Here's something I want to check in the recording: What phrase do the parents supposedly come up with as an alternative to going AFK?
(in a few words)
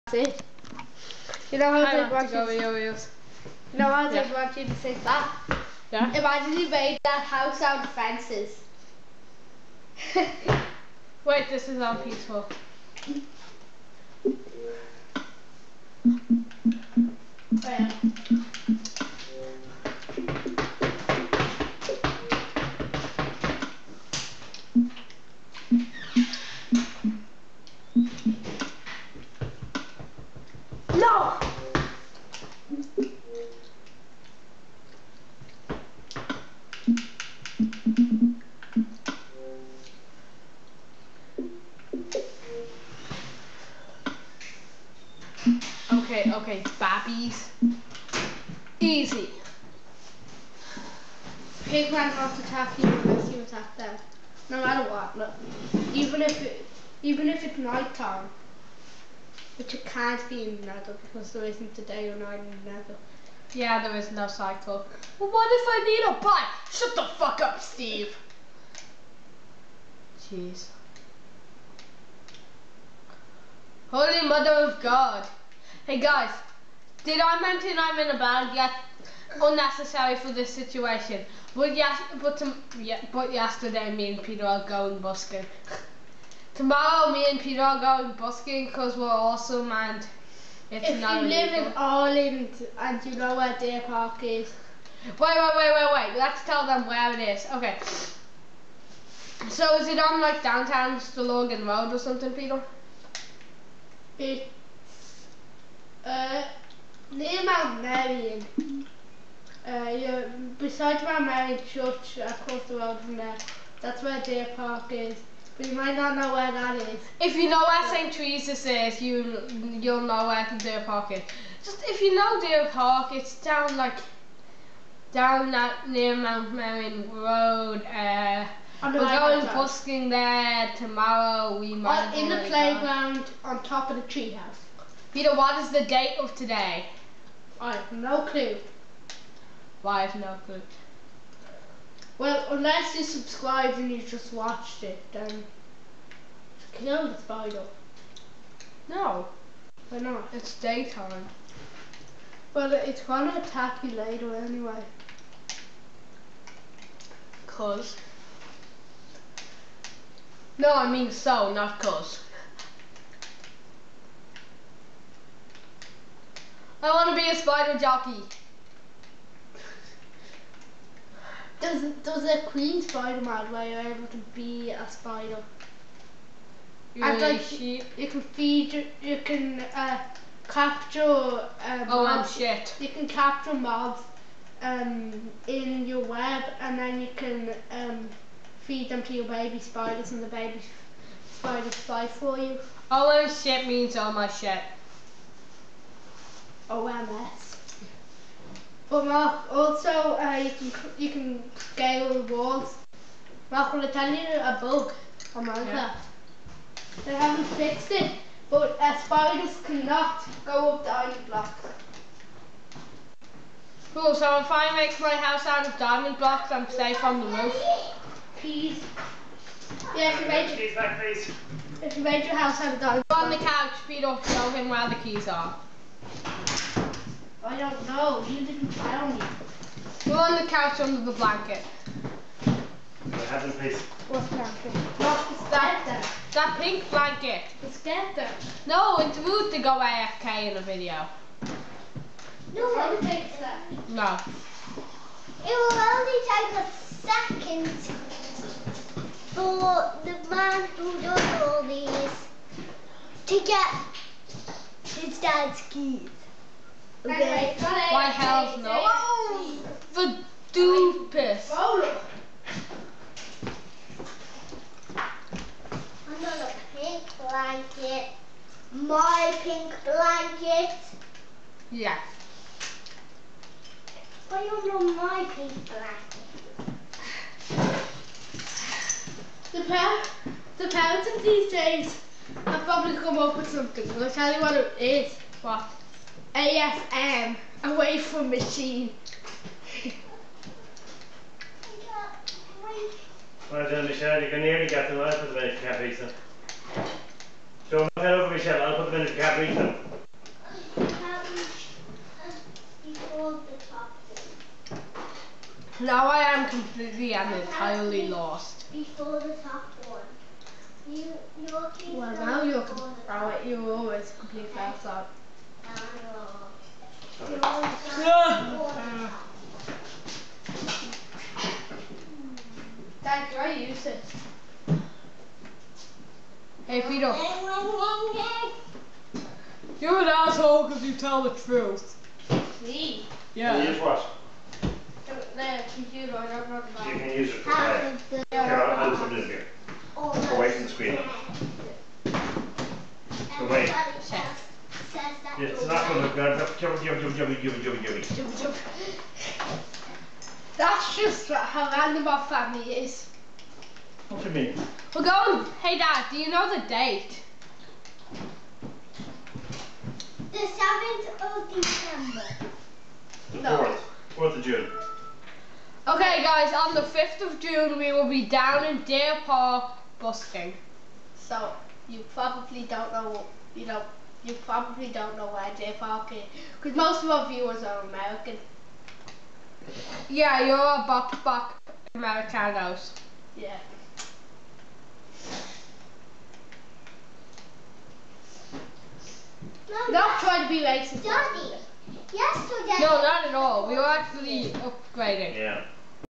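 Away from machine.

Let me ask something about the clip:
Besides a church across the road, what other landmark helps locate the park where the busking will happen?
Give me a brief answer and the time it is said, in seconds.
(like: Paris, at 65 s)
St. Teresa's, at 117 s.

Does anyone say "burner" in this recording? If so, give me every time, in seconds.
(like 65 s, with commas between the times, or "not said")
not said.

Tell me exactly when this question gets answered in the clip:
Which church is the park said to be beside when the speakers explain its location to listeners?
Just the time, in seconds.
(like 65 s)
111 s.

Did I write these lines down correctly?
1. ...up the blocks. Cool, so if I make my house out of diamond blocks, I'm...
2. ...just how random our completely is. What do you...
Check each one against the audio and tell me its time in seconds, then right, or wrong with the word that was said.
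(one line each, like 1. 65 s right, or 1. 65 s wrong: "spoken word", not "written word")
1. 210 s right
2. 350 s wrong: "family", not "completely".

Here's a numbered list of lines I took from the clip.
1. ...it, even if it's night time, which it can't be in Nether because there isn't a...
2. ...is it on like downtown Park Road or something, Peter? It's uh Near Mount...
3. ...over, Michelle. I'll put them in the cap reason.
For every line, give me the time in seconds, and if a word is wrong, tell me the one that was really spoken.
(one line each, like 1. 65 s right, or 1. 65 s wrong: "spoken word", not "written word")
1. 56 s right
2. 99 s wrong: "Stillorgan", not "Park"
3. 298 s right.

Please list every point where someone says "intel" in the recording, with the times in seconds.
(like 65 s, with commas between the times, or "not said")
not said.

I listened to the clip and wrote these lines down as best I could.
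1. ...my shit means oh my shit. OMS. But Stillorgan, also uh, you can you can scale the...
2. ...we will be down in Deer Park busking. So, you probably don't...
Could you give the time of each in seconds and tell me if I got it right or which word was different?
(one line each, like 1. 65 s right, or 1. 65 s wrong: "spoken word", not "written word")
1. 193 s wrong: "Mark", not "Stillorgan"
2. 367 s right.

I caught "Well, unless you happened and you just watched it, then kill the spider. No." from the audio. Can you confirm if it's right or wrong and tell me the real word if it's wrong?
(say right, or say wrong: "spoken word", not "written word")
wrong: "subscribed", not "happened".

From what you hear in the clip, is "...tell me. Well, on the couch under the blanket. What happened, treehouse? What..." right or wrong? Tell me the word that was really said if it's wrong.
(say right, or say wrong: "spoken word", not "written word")
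wrong: "please", not "treehouse".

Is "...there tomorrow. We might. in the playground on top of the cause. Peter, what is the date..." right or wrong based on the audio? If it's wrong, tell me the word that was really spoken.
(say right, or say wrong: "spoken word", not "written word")
wrong: "treehouse", not "cause".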